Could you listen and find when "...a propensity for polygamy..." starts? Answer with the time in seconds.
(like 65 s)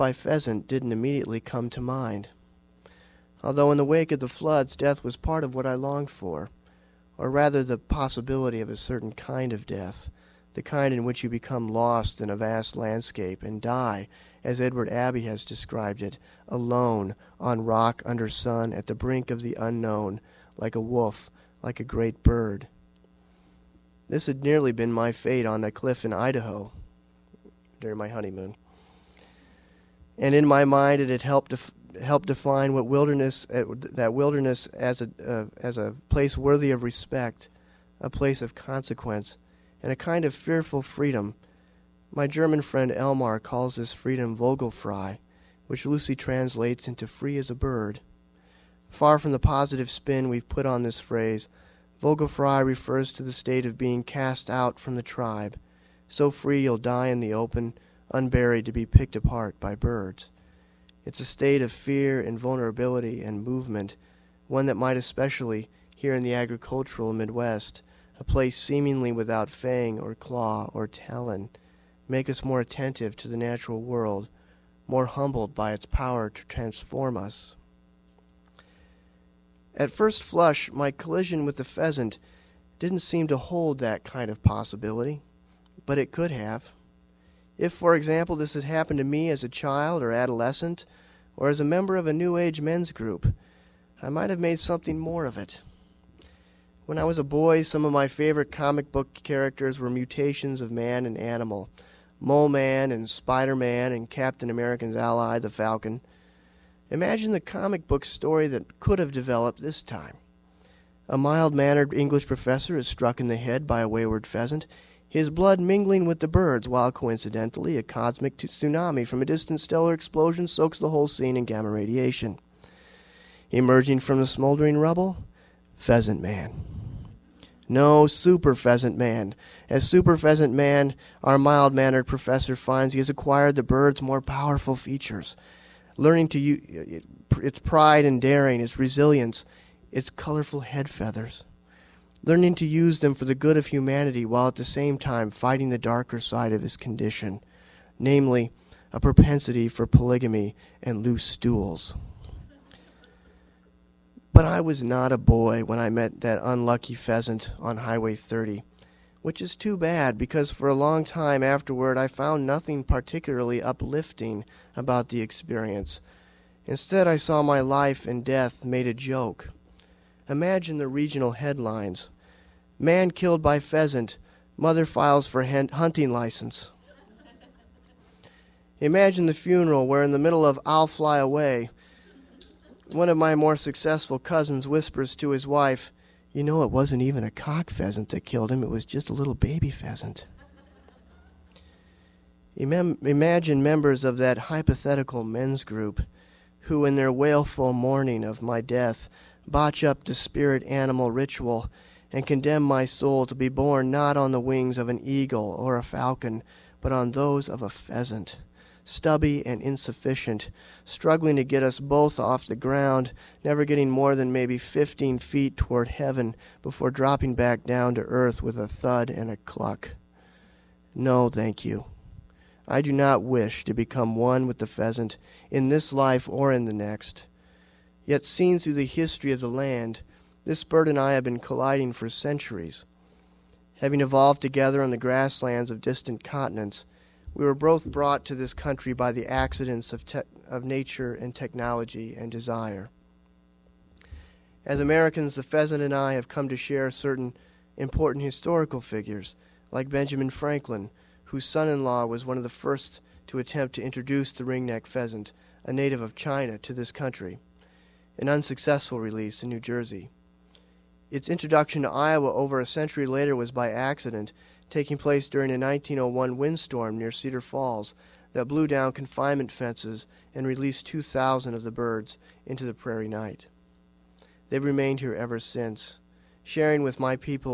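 148 s.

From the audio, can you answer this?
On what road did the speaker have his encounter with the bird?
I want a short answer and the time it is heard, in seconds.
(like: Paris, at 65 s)
Highway 30, at 157 s.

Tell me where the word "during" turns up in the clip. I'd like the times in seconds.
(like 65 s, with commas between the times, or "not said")
27 s, 265 s.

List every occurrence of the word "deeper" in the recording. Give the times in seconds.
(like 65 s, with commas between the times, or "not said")
not said.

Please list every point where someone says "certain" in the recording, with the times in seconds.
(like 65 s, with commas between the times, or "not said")
8 s, 246 s.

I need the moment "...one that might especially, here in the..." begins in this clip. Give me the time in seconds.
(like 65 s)
64 s.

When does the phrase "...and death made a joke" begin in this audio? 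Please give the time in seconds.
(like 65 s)
168 s.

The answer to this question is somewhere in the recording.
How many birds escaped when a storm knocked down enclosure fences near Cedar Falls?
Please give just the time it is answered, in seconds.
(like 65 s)
270 s.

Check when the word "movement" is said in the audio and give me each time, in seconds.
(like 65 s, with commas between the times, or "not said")
63 s.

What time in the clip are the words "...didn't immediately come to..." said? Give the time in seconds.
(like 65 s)
0 s.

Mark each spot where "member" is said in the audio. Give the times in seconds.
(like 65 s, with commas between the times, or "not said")
91 s, 193 s.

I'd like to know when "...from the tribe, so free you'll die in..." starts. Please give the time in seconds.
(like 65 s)
54 s.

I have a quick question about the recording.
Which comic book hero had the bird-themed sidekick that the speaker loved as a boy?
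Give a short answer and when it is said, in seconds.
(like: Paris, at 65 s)
Captain America, at 104 s.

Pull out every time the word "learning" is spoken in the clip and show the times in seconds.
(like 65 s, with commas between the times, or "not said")
135 s, 142 s.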